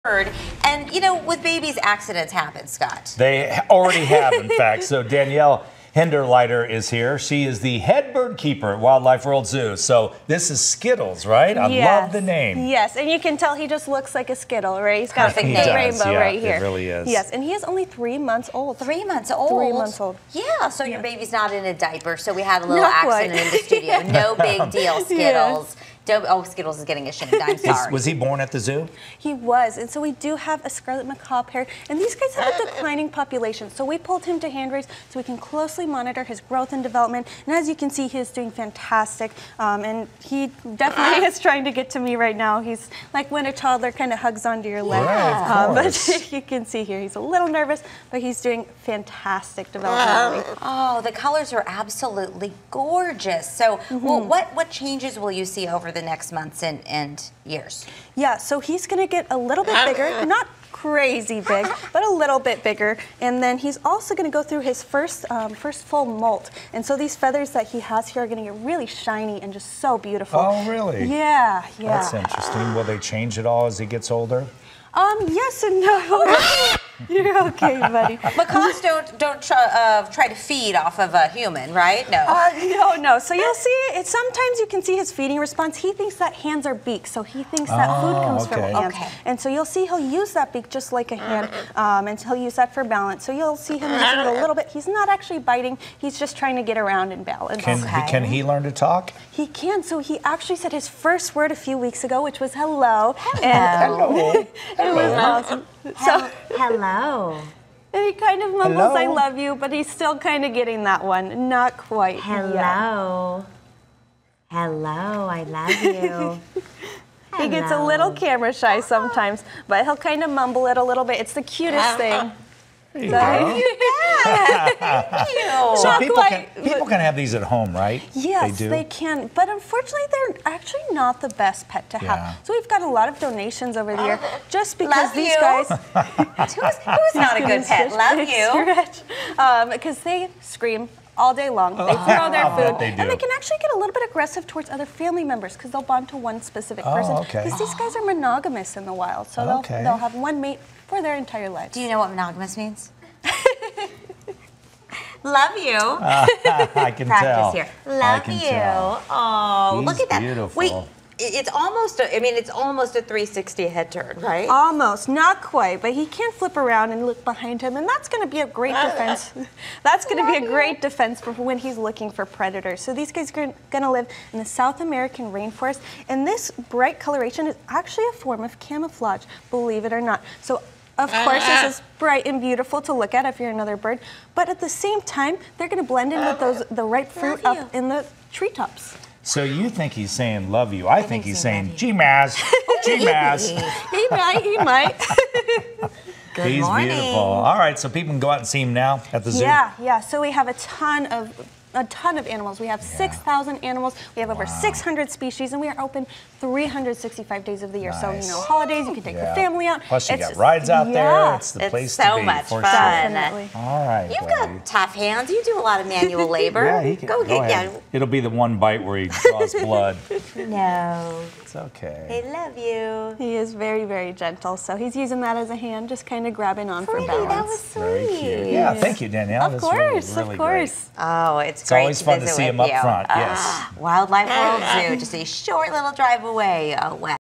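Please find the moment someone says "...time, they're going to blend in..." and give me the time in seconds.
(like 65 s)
185 s.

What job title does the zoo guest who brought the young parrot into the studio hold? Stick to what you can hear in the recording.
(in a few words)
Head bird keeper.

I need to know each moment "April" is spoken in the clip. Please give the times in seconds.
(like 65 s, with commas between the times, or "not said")
not said.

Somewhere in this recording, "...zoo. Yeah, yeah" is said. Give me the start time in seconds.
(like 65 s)
199 s.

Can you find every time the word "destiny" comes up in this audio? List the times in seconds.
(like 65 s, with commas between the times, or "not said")
not said.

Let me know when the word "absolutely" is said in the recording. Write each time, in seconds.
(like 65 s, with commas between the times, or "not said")
51 s.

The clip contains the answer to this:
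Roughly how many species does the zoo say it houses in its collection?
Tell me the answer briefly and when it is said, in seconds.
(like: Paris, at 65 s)
Over 600, at 204 s.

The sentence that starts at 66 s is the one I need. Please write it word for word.
And so these feathers that he has here are going to get really shiny and just so beautiful.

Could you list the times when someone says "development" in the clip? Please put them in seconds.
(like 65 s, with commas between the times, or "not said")
36 s, 49 s.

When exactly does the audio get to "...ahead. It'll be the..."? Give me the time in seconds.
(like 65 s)
217 s.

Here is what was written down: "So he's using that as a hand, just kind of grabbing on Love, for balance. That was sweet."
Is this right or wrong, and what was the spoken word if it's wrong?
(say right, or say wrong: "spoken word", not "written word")
wrong: "Pretty", not "Love".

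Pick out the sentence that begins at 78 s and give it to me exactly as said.
Macaws don't don't try, uh, try to feed off of a human, right?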